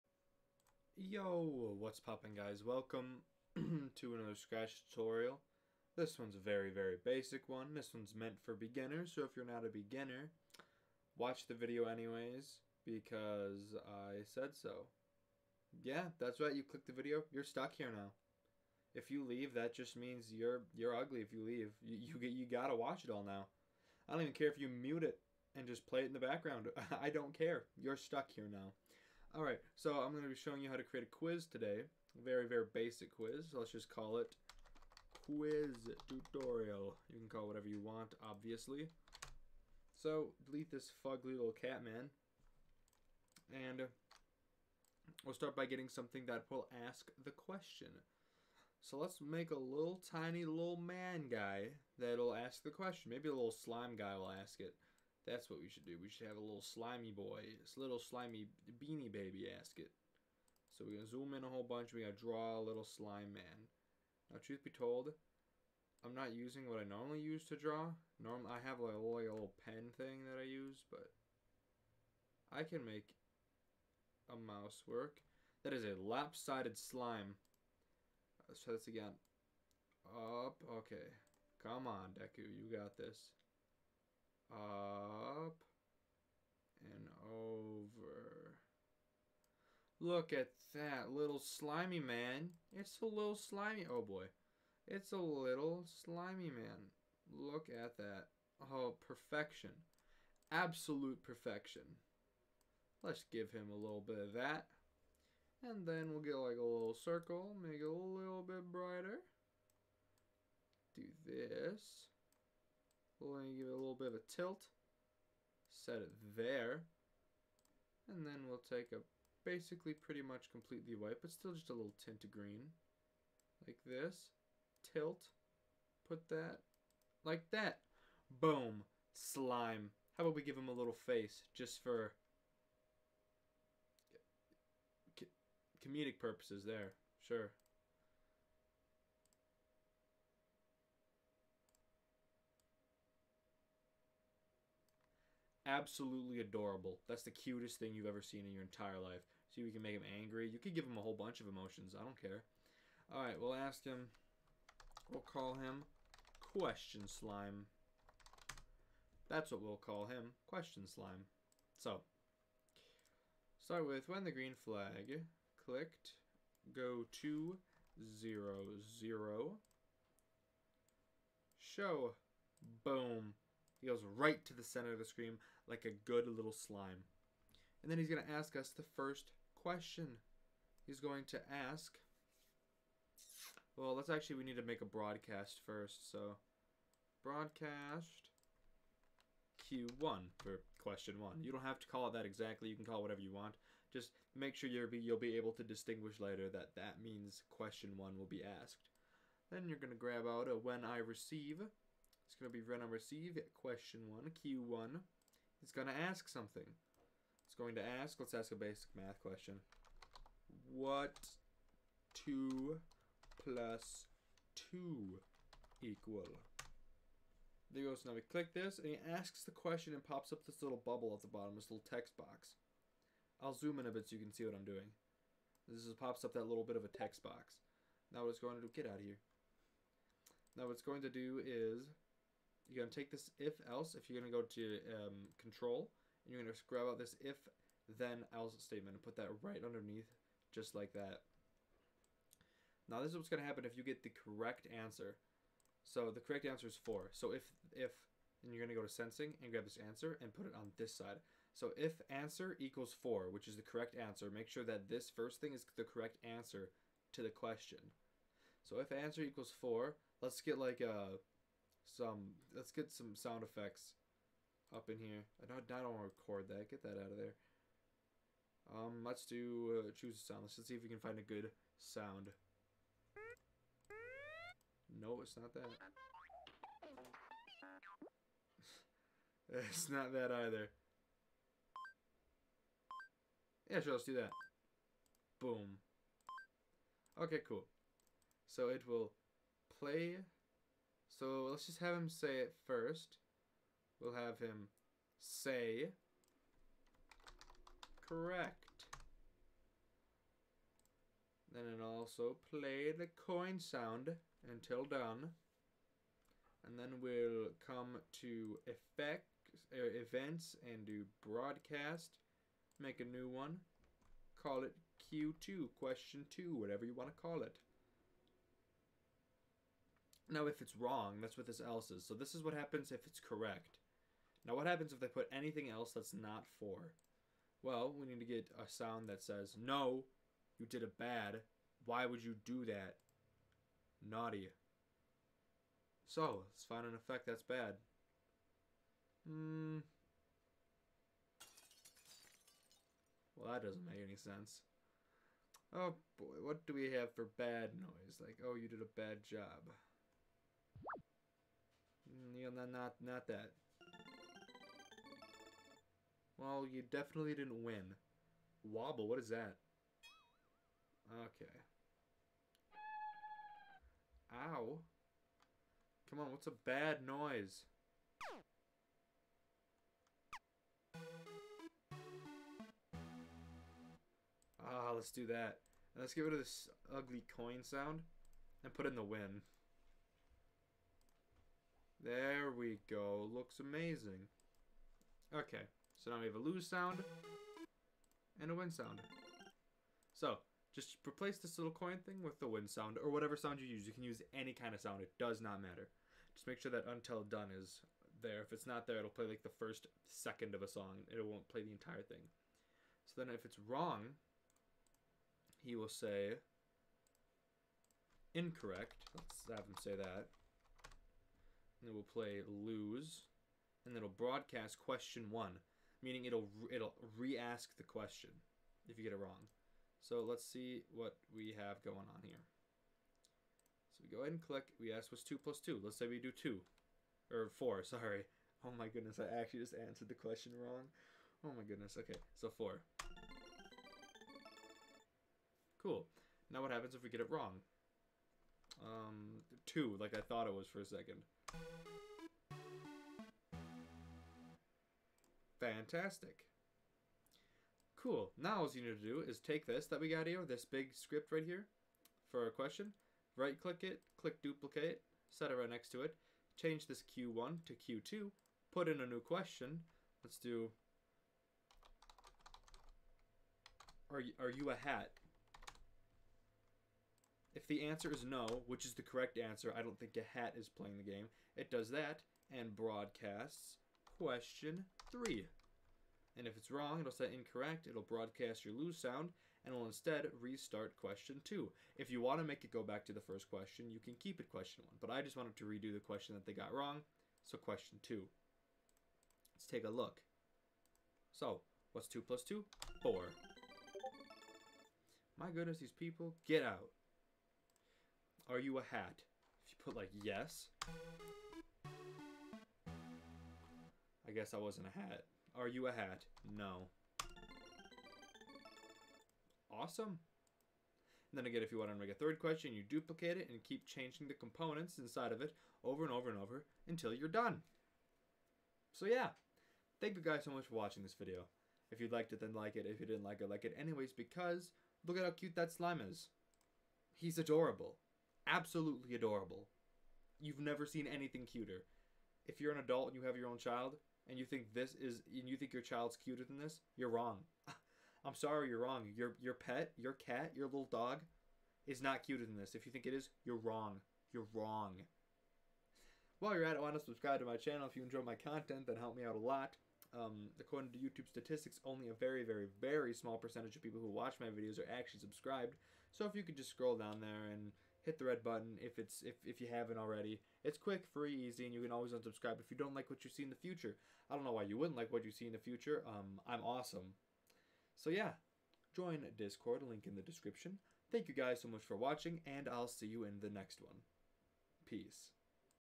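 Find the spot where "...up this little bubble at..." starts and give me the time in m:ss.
3:40.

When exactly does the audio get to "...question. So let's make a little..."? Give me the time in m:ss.
0:47.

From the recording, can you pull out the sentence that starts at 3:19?
Then you're going to grab out a when I receive it's going to be run on receive question 1, Q1.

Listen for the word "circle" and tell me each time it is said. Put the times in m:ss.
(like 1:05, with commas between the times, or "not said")
1:47.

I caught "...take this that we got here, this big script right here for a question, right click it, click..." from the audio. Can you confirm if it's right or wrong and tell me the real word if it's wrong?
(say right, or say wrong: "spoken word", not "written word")
right.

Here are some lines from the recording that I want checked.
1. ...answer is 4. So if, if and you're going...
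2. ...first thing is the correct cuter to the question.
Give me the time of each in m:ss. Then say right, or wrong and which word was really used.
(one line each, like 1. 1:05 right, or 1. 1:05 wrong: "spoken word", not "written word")
1. 4:06 right
2. 4:15 wrong: "answer", not "cuter".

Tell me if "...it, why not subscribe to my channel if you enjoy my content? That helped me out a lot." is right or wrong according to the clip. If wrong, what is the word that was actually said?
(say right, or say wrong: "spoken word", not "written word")
right.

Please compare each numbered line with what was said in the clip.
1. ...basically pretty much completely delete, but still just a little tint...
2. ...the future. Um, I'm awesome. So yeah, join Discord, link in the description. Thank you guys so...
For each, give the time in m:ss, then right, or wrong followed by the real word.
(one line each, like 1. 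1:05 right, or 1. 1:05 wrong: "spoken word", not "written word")
1. 1:59 wrong: "white", not "delete"
2. 9:25 right.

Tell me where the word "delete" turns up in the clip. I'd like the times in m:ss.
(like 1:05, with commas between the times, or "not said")
0:40.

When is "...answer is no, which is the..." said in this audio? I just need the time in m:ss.
7:47.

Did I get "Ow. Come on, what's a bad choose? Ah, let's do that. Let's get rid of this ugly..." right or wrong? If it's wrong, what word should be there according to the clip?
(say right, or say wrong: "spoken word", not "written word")
wrong: "noise", not "choose".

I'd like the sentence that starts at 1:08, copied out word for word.
Normally, I have like a little pen thing that I use, but I can make a mouse work.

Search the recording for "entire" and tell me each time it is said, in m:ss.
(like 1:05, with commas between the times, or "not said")
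2:28, 6:41.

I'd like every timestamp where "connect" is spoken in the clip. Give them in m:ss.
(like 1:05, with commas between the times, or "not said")
not said.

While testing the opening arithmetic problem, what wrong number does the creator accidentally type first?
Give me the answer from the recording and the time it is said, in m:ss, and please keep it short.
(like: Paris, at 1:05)
2, at 7:05.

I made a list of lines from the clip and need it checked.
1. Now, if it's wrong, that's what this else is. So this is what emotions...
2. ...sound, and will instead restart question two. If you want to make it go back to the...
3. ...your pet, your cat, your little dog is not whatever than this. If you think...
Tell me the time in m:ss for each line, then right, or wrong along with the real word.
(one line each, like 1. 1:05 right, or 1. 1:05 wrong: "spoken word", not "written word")
1. 5:20 wrong: "happens", not "emotions"
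2. 7:59 right
3. 8:59 wrong: "cuter", not "whatever".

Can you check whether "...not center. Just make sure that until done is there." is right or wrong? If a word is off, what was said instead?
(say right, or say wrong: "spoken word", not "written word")
wrong: "matter", not "center".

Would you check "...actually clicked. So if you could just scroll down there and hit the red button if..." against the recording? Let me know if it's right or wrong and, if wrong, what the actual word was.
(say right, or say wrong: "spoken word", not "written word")
wrong: "subscribed", not "clicked".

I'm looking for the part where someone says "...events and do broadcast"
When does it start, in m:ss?
5:10.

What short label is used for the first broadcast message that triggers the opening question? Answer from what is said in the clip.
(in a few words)
Q1.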